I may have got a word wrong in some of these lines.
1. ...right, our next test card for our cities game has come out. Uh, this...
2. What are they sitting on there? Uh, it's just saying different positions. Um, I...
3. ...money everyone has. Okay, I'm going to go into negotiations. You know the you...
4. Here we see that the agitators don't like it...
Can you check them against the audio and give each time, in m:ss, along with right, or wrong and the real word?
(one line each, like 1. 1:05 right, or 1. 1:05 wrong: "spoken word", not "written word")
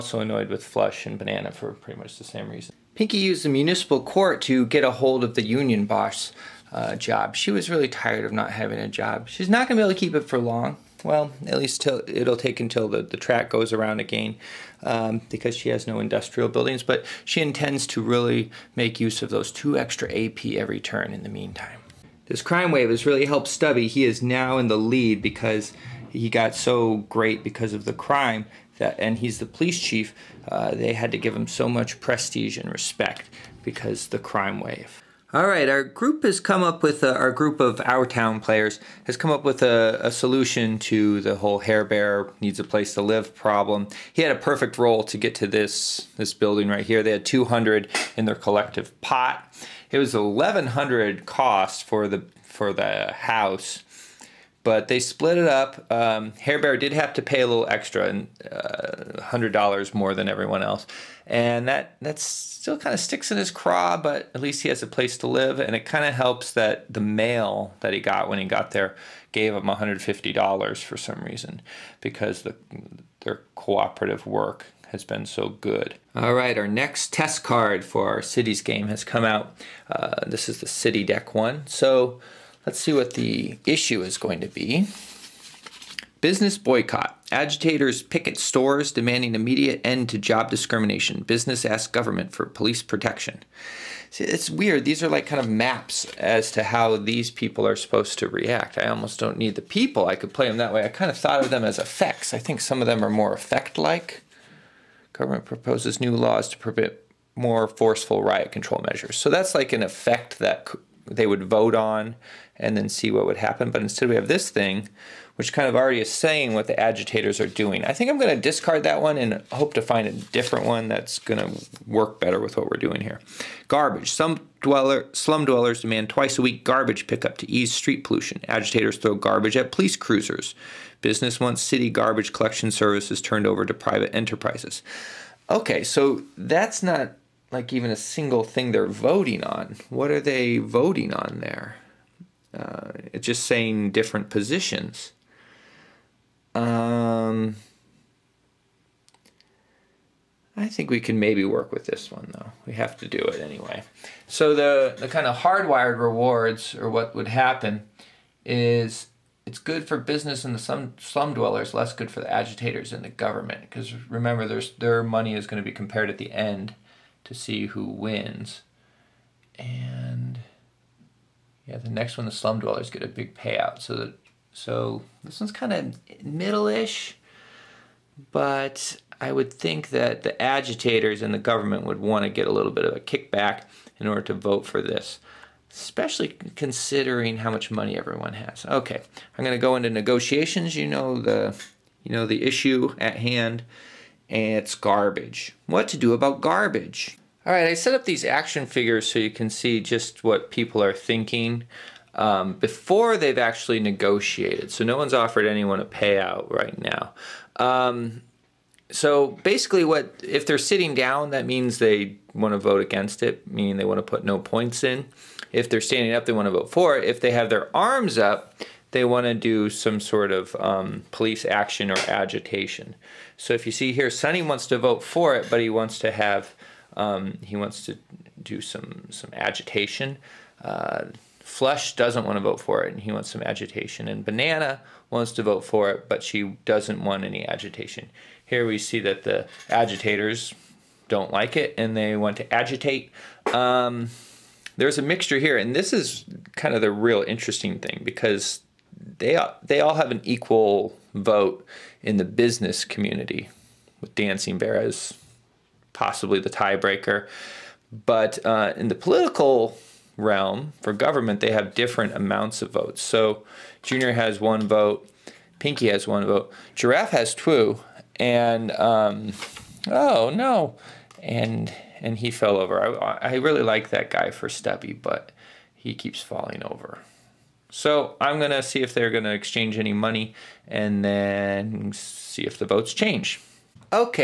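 1. 1:16 right
2. 2:19 wrong: "voting", not "sitting"
3. 3:07 right
4. 3:58 right.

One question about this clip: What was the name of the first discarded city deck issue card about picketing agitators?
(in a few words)
Business boycott.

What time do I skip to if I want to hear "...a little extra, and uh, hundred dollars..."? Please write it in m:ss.
0:57.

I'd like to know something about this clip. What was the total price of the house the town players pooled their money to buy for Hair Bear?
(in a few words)
1100.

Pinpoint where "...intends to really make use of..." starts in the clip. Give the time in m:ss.
0:17.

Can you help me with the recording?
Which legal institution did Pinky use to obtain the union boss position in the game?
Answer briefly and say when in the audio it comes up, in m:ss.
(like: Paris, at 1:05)
Municipal court, at 0:03.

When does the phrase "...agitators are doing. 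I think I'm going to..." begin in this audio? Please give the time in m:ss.
1:56.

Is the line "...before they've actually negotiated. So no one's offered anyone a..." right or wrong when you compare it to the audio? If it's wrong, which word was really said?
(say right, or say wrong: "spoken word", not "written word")
right.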